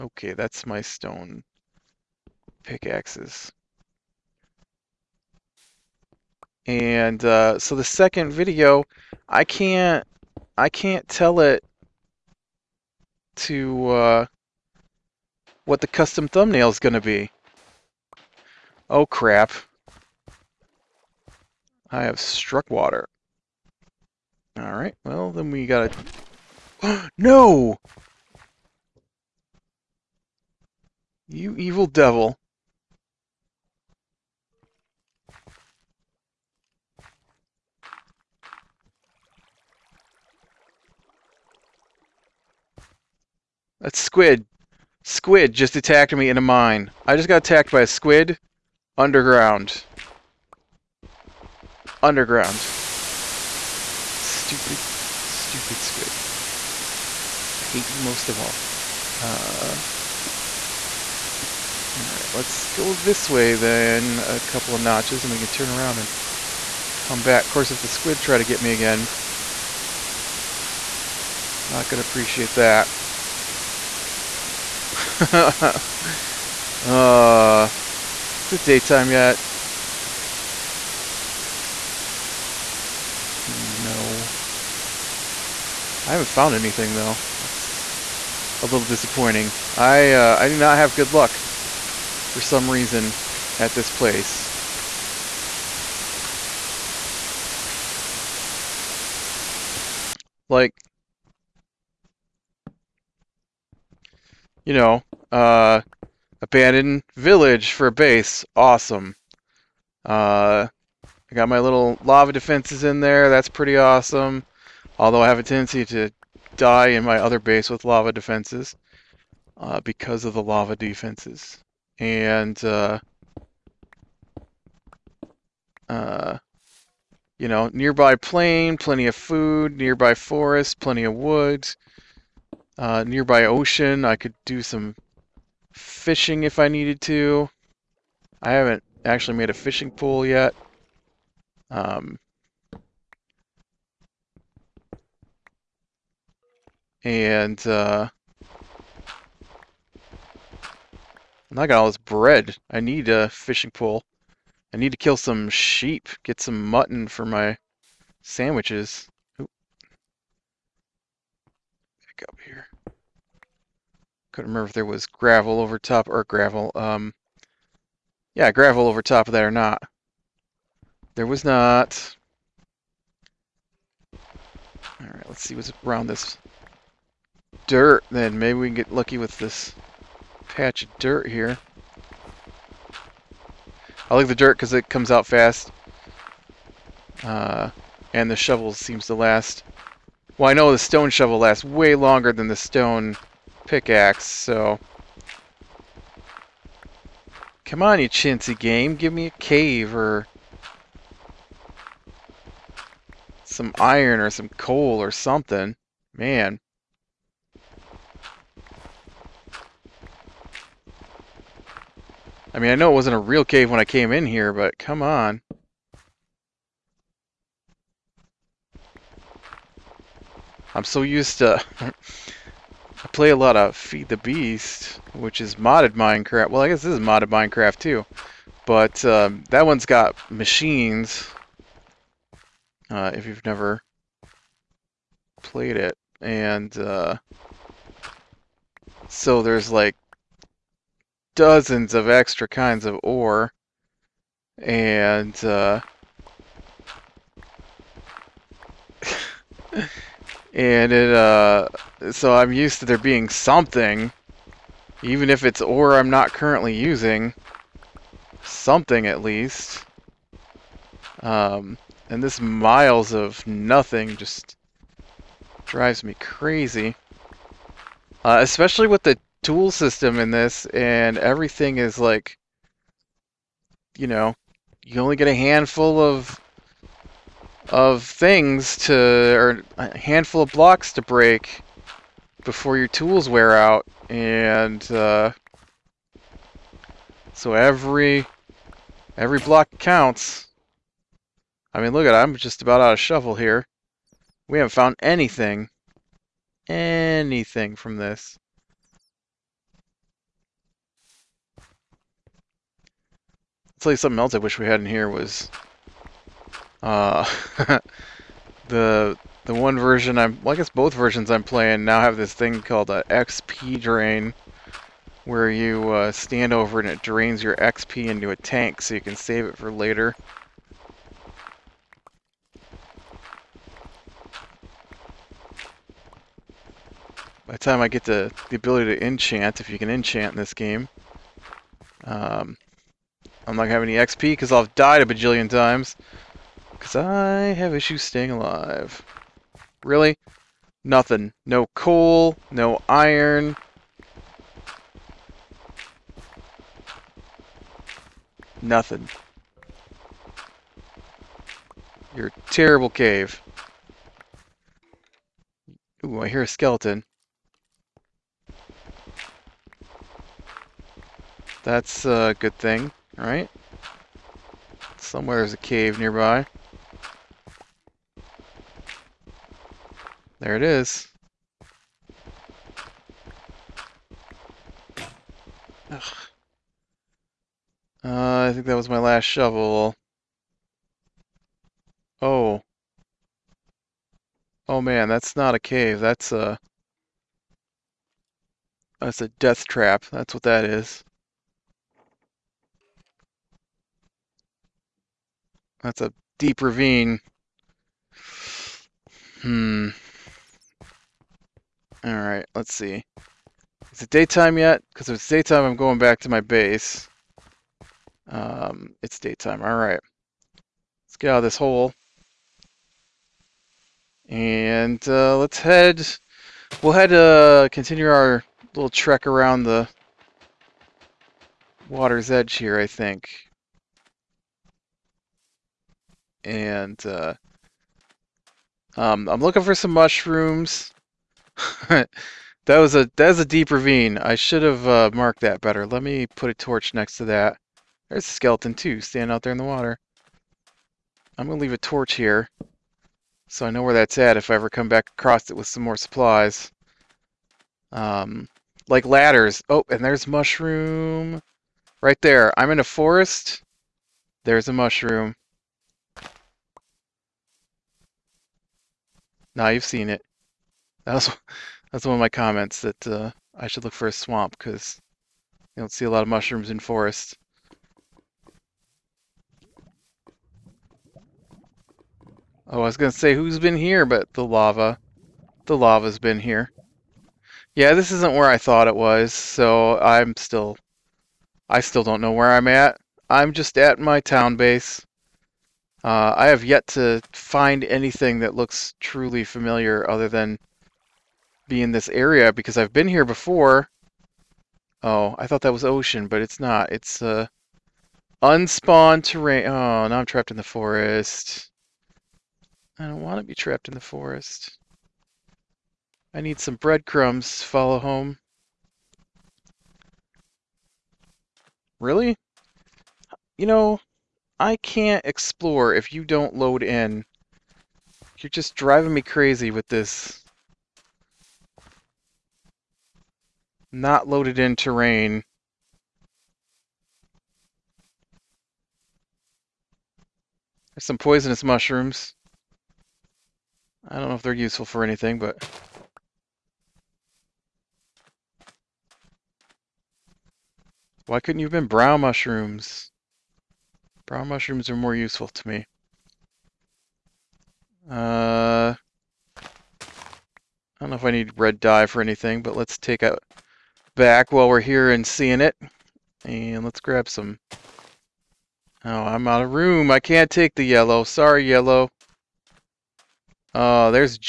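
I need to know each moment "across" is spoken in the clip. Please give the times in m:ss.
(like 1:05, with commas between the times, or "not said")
7:25.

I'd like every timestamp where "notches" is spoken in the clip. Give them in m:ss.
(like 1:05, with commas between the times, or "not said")
1:04.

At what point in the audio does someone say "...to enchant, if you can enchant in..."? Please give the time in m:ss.
5:28.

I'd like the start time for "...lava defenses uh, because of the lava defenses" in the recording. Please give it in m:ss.
1:57.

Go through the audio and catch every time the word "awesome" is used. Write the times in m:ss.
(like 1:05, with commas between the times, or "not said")
1:48, 1:53.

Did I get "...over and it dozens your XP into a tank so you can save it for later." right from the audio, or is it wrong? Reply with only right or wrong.
wrong.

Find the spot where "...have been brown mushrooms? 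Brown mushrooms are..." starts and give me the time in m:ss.
9:01.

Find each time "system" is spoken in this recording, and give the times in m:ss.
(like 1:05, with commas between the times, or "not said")
4:29.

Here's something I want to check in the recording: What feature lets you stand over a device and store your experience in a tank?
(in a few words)
XP drain.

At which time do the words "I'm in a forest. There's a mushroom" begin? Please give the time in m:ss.
7:32.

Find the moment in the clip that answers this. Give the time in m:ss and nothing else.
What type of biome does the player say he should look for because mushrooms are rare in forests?
7:44.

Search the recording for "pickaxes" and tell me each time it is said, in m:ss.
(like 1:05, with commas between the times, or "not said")
0:02, 3:13.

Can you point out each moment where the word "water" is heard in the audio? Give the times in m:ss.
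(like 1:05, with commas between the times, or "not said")
0:22, 7:01, 7:19.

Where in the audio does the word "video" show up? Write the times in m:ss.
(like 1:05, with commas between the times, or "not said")
0:08.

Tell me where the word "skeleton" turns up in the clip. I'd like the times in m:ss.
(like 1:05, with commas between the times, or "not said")
5:56, 7:18.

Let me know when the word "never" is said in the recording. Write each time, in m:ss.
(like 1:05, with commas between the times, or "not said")
3:53.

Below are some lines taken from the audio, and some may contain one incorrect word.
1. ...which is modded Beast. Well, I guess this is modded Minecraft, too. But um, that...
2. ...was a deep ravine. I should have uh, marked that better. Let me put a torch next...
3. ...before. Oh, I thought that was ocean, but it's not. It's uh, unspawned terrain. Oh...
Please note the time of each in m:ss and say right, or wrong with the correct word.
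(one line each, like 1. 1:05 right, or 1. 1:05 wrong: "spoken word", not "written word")
1. 3:45 wrong: "Minecraft", not "Beast"
2. 7:13 right
3. 8:13 right.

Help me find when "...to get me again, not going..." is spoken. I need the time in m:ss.
1:08.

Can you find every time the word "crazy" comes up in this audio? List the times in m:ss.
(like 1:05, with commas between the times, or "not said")
4:26, 8:39.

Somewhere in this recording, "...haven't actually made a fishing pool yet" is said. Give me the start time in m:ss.
2:18.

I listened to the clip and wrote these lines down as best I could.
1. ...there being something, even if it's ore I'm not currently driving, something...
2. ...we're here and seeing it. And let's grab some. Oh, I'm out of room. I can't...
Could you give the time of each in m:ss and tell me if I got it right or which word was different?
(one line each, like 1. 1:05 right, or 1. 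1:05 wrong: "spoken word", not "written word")
1. 4:12 wrong: "using", not "driving"
2. 9:14 right.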